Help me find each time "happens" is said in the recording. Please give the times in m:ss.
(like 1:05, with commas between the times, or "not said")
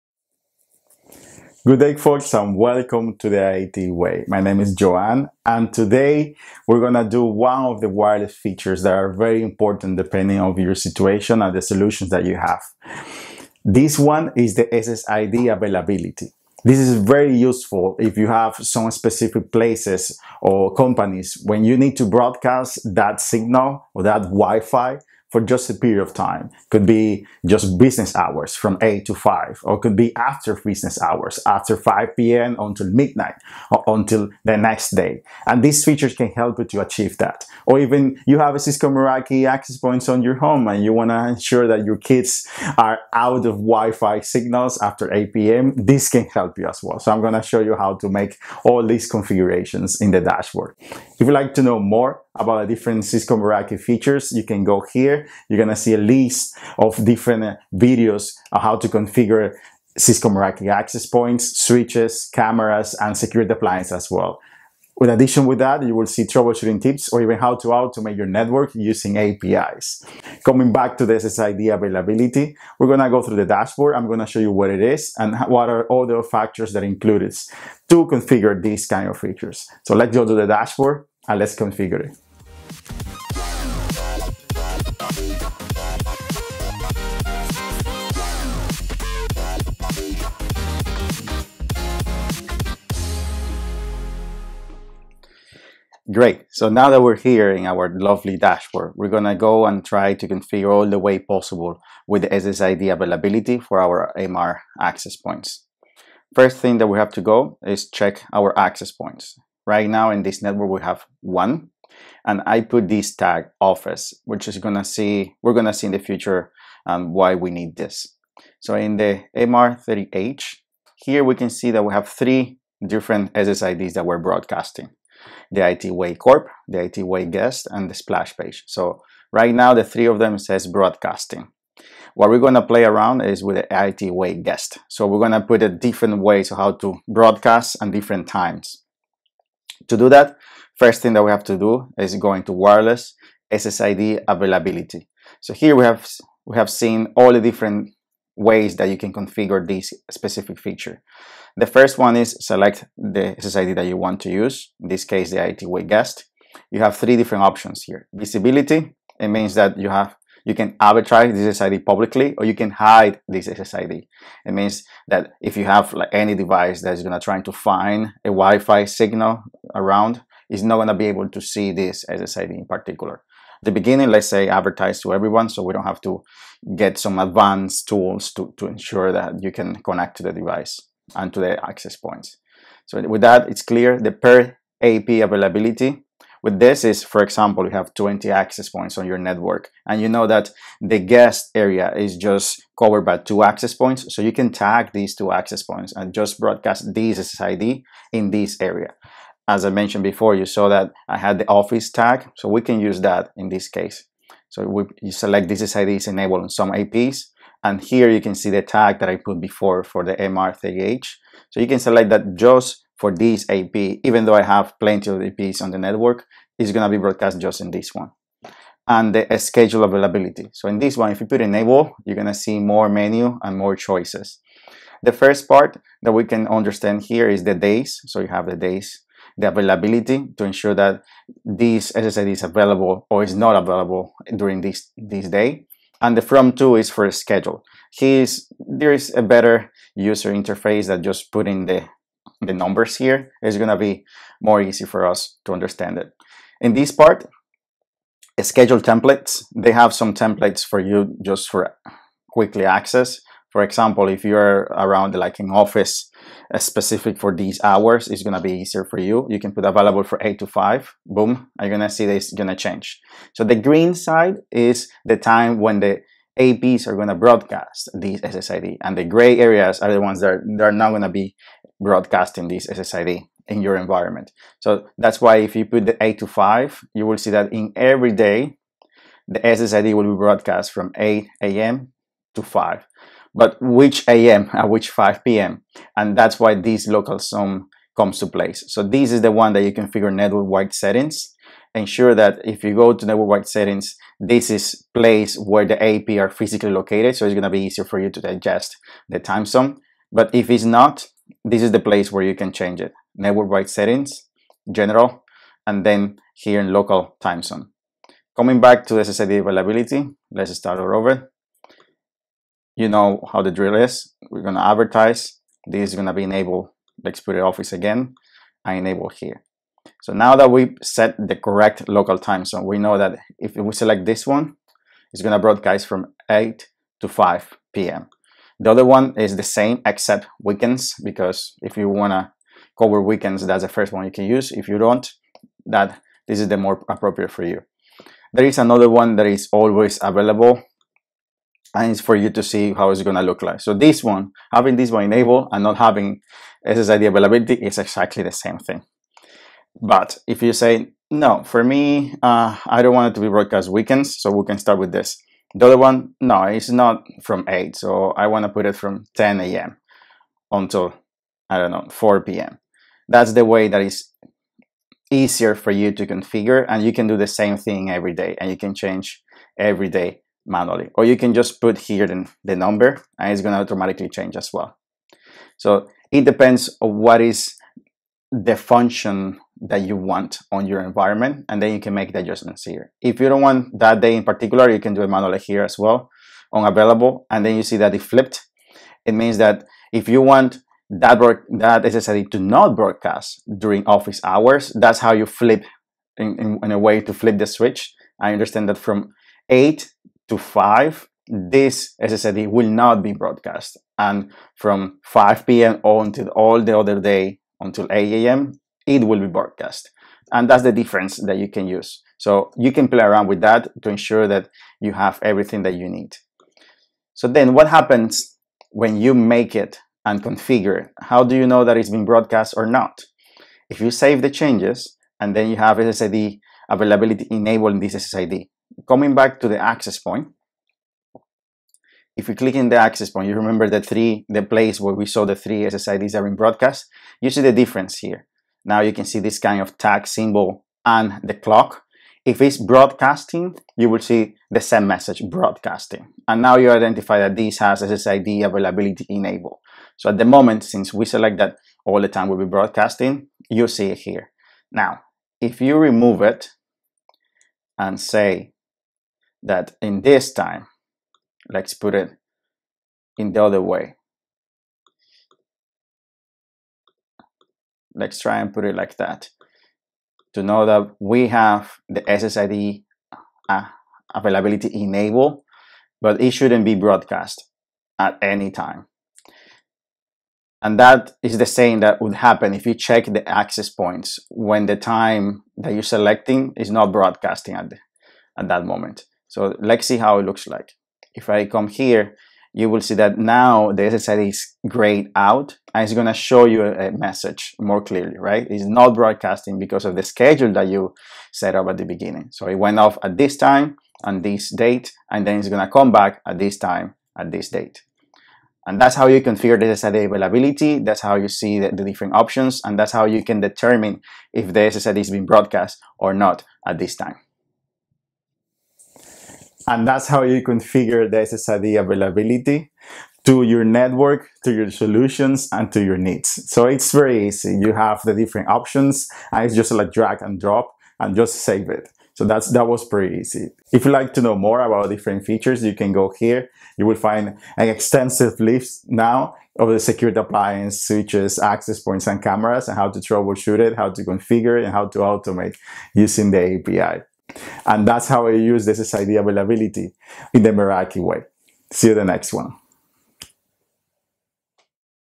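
6:57, 8:02.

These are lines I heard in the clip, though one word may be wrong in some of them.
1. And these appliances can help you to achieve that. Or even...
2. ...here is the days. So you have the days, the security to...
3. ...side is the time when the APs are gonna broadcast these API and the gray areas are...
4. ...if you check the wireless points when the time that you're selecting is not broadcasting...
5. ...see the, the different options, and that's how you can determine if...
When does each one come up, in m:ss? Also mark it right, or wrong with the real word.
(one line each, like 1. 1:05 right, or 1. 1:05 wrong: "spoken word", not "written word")
1. 0:35 wrong: "features", not "appliances"
2. 3:47 wrong: "availability", not "security"
3. 4:23 wrong: "SSID", not "API"
4. 8:02 wrong: "access", not "wireless"
5. 8:31 right.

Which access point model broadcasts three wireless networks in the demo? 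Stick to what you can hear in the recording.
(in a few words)
MR30H.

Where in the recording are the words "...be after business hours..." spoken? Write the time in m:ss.
0:29.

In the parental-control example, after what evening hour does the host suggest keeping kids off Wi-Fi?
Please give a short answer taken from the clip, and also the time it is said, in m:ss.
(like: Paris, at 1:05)
8 p.m., at 0:45.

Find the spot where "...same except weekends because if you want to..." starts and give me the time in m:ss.
5:29.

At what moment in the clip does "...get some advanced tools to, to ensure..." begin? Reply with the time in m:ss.
2:56.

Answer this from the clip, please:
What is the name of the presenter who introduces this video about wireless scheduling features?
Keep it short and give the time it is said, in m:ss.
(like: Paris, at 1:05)
Joanne, at 0:04.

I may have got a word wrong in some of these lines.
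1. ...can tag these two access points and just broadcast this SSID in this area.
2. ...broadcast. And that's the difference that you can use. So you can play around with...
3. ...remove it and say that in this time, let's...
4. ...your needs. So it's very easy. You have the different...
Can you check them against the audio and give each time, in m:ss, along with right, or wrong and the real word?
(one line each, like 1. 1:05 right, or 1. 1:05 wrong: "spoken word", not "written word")
1. 3:14 right
2. 6:49 right
3. 7:35 right
4. 8:45 right.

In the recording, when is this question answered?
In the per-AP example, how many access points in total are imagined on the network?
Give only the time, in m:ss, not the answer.
3:07.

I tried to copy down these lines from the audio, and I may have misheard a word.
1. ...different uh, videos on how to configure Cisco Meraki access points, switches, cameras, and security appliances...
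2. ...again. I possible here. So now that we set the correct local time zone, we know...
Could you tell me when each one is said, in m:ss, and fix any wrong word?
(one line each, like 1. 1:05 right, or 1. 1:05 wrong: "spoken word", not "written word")
1. 0:57 right
2. 5:17 wrong: "enable", not "possible".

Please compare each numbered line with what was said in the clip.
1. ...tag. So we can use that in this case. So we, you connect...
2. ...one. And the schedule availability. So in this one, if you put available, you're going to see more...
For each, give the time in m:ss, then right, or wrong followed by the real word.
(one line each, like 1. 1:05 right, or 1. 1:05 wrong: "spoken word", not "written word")
1. 3:21 wrong: "select", not "connect"
2. 3:38 wrong: "enable", not "available".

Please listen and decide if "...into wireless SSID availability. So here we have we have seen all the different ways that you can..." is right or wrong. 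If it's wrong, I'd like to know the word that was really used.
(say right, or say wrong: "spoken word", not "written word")
right.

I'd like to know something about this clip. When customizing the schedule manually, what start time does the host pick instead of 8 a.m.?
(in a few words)
10 a.m.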